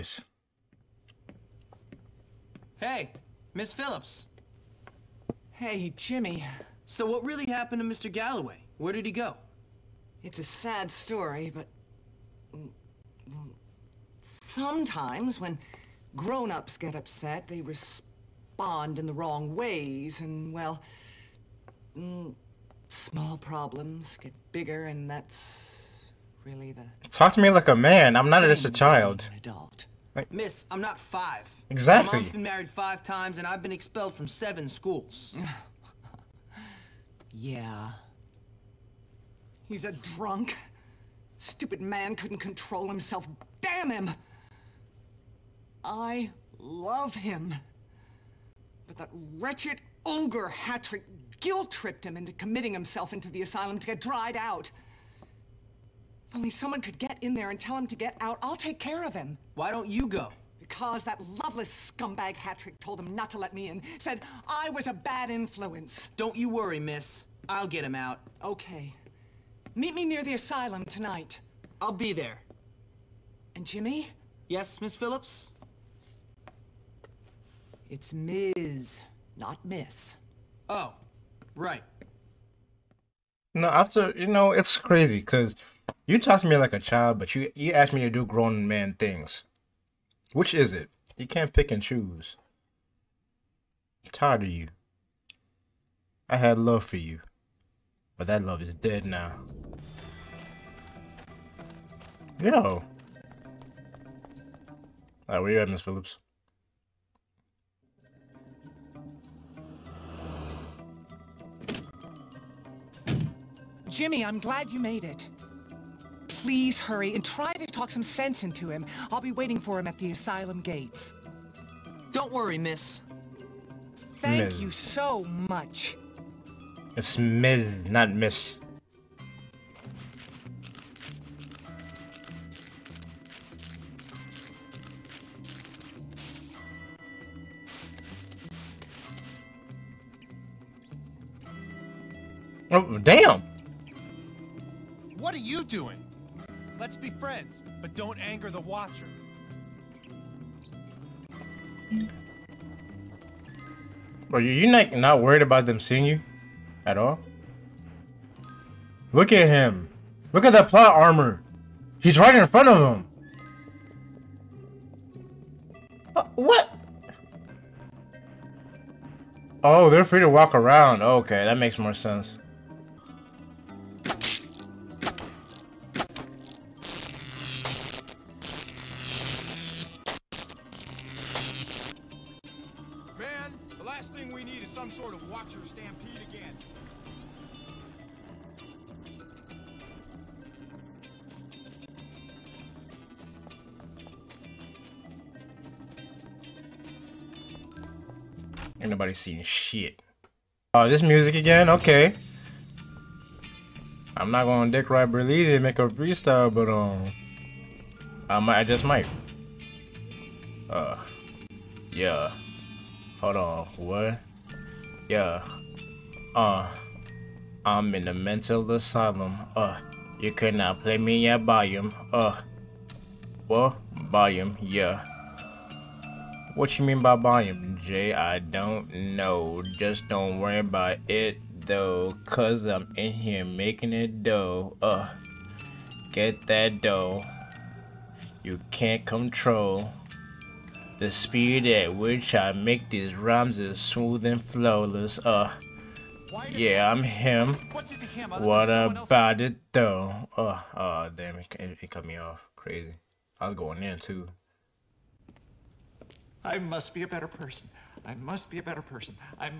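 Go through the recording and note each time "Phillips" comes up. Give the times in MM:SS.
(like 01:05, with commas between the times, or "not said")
00:03, 01:14, 01:45.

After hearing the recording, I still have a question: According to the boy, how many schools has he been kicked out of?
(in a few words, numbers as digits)
7.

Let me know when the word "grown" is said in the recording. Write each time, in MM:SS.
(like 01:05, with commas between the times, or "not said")
00:16, 01:28.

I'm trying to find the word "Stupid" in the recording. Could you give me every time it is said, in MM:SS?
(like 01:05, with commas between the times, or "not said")
00:41.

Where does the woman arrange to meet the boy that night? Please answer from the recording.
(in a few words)
Near the asylum.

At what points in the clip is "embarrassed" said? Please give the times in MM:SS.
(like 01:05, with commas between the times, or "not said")
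not said.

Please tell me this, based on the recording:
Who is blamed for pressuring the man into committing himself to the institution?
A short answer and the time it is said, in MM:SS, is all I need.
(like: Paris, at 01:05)
Olger Hattrick, at 00:50.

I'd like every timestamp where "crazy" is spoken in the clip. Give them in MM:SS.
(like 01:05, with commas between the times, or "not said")
01:24, 04:12.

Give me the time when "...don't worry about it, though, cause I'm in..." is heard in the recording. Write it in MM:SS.
03:50.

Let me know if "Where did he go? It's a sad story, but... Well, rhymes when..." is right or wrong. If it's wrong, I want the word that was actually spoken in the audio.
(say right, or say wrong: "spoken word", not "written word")
wrong: "sometimes", not "rhymes".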